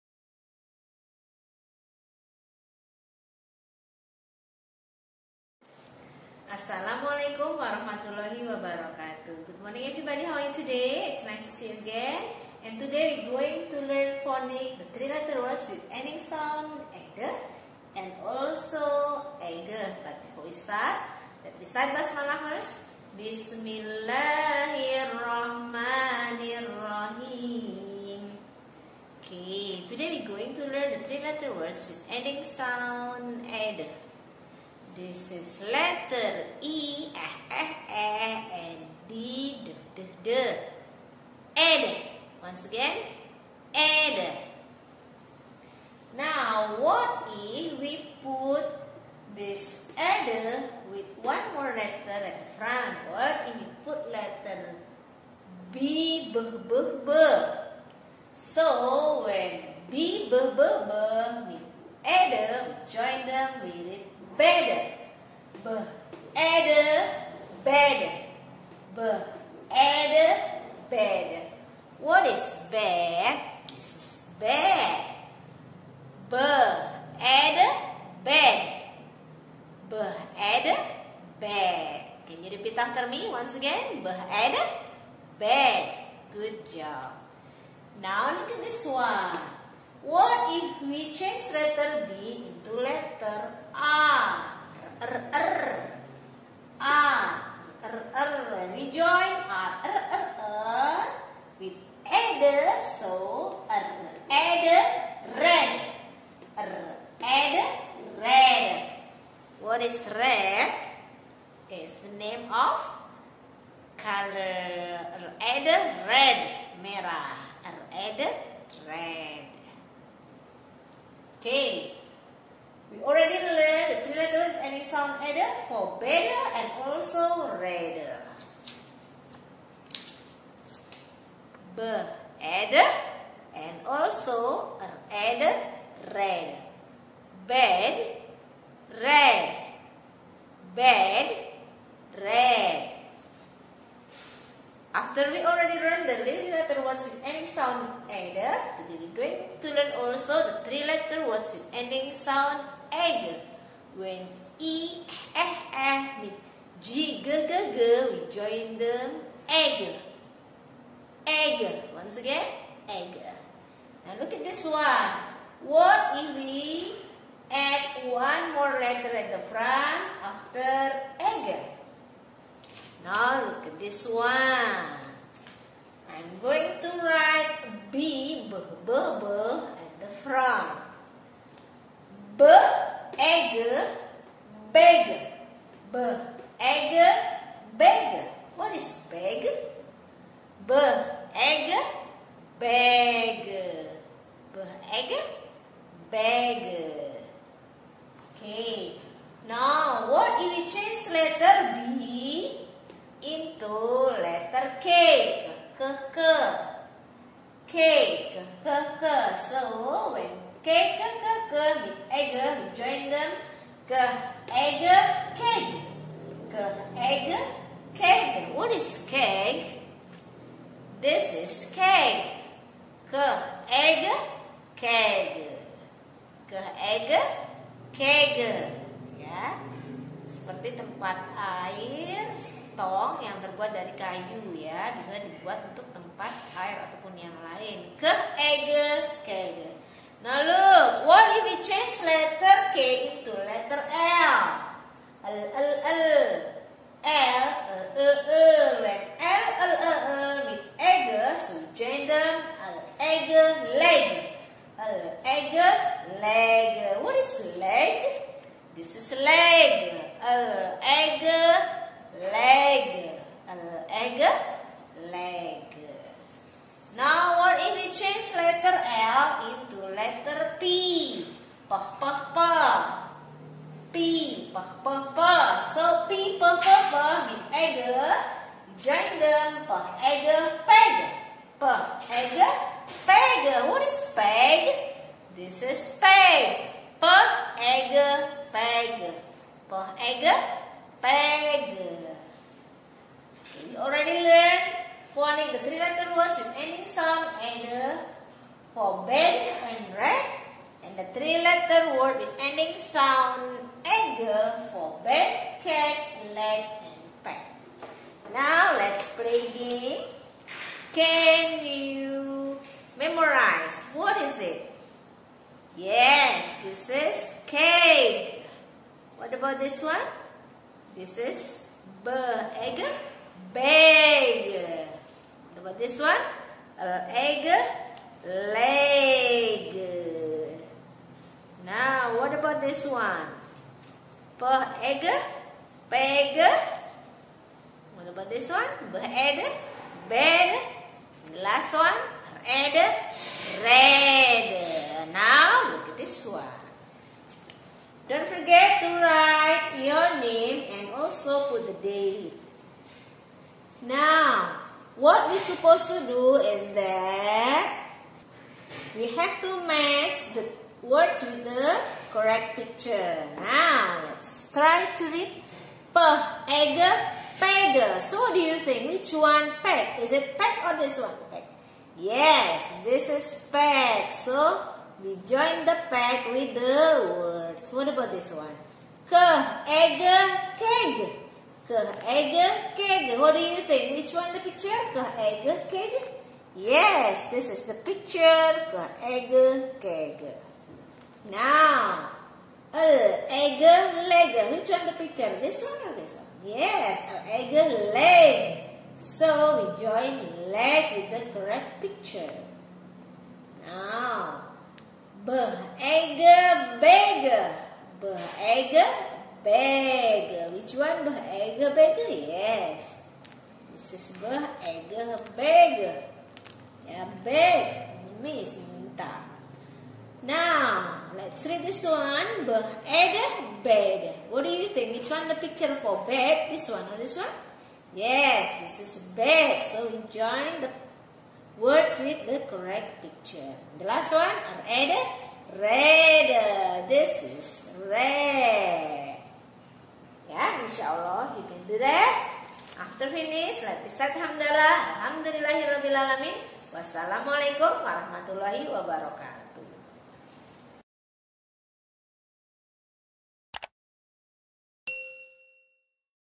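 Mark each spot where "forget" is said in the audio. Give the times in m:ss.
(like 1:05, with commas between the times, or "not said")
5:48.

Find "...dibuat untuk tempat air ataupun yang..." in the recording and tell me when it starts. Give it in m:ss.
3:55.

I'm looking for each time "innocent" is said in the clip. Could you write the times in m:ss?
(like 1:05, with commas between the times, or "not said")
not said.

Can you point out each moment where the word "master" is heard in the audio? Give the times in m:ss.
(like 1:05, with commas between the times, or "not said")
not said.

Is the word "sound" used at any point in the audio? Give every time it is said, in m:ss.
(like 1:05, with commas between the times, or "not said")
0:16, 0:32, 2:04, 2:27, 2:32, 4:56, 5:02.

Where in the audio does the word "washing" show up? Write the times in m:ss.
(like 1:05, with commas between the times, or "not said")
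not said.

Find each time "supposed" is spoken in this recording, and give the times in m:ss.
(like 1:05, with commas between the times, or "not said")
5:55.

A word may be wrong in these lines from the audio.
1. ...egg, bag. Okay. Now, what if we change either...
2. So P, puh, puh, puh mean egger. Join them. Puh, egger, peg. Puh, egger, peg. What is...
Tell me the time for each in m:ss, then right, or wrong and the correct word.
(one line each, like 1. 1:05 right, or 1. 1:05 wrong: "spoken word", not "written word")
1. 3:14 wrong: "letter", not "either"
2. 4:35 right.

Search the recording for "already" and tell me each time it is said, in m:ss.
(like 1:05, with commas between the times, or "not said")
2:03, 2:25, 4:53.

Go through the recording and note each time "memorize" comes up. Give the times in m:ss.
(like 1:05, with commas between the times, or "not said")
5:12.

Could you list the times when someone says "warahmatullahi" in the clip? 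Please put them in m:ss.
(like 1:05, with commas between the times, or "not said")
0:07, 7:27.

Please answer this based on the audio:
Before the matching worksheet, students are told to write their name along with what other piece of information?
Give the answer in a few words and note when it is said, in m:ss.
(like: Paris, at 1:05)
the date, at 5:51.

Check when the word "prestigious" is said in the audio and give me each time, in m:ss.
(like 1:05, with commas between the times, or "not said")
not said.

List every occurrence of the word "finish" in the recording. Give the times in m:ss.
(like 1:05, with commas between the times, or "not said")
7:23.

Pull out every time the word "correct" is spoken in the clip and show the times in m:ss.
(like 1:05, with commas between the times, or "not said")
6:02, 6:41, 7:12.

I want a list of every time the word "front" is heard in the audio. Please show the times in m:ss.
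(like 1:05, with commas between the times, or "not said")
0:52, 2:49, 3:00.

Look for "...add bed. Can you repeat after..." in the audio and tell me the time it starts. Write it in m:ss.
1:20.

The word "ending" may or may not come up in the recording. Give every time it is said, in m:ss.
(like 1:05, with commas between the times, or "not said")
0:15, 0:32, 2:04, 2:27, 2:31, 4:56, 5:02.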